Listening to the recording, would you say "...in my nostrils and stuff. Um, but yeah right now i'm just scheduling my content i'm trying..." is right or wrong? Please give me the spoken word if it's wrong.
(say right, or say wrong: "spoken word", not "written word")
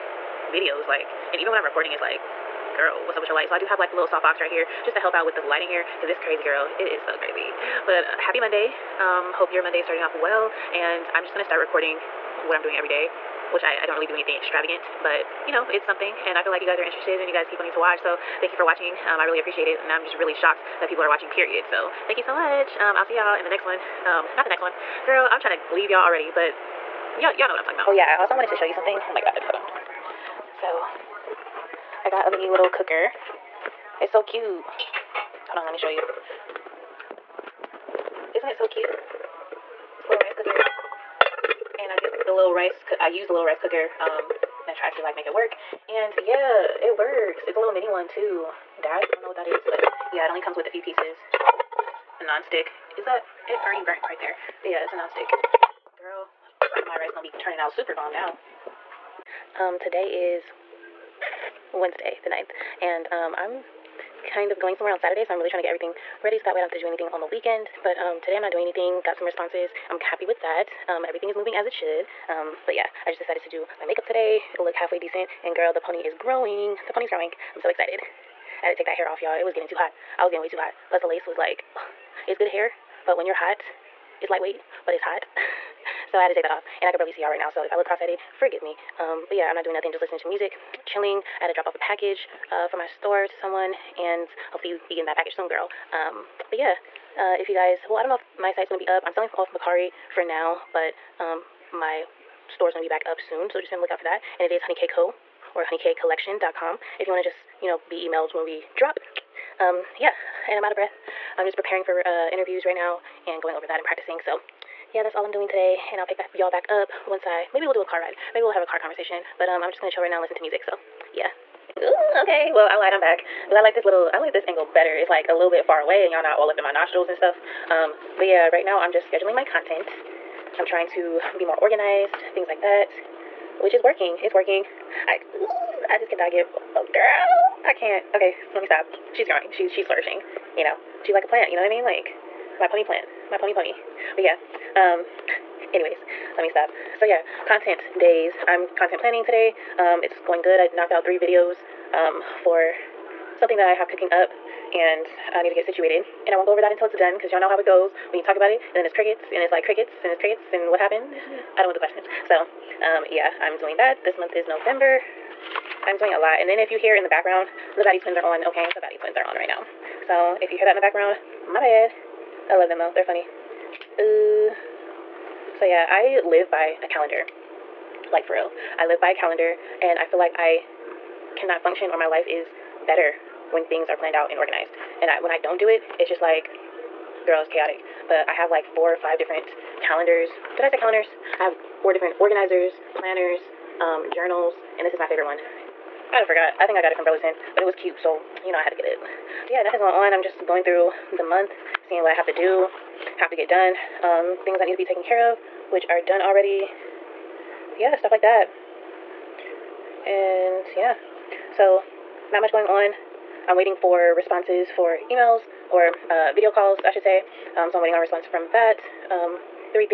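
right.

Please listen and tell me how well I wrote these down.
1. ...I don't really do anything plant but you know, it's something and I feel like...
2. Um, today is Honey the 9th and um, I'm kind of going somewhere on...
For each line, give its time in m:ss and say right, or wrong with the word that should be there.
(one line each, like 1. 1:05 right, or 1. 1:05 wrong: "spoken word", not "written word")
1. 0:13 wrong: "extravagant", not "plant"
2. 0:59 wrong: "Wednesday", not "Honey".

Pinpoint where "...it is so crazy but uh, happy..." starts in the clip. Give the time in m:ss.
0:06.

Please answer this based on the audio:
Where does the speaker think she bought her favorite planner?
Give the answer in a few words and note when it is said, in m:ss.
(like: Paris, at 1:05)
Burlington, at 3:17.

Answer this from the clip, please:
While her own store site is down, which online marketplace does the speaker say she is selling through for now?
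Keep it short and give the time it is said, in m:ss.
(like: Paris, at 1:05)
Mercari, at 1:39.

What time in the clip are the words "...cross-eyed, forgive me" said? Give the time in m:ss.
1:27.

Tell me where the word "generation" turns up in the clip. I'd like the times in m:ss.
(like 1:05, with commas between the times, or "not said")
not said.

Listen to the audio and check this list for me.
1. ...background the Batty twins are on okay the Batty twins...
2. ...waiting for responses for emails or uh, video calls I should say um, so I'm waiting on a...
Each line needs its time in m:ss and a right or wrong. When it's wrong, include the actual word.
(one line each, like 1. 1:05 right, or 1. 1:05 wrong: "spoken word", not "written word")
1. 2:47 right
2. 3:33 right.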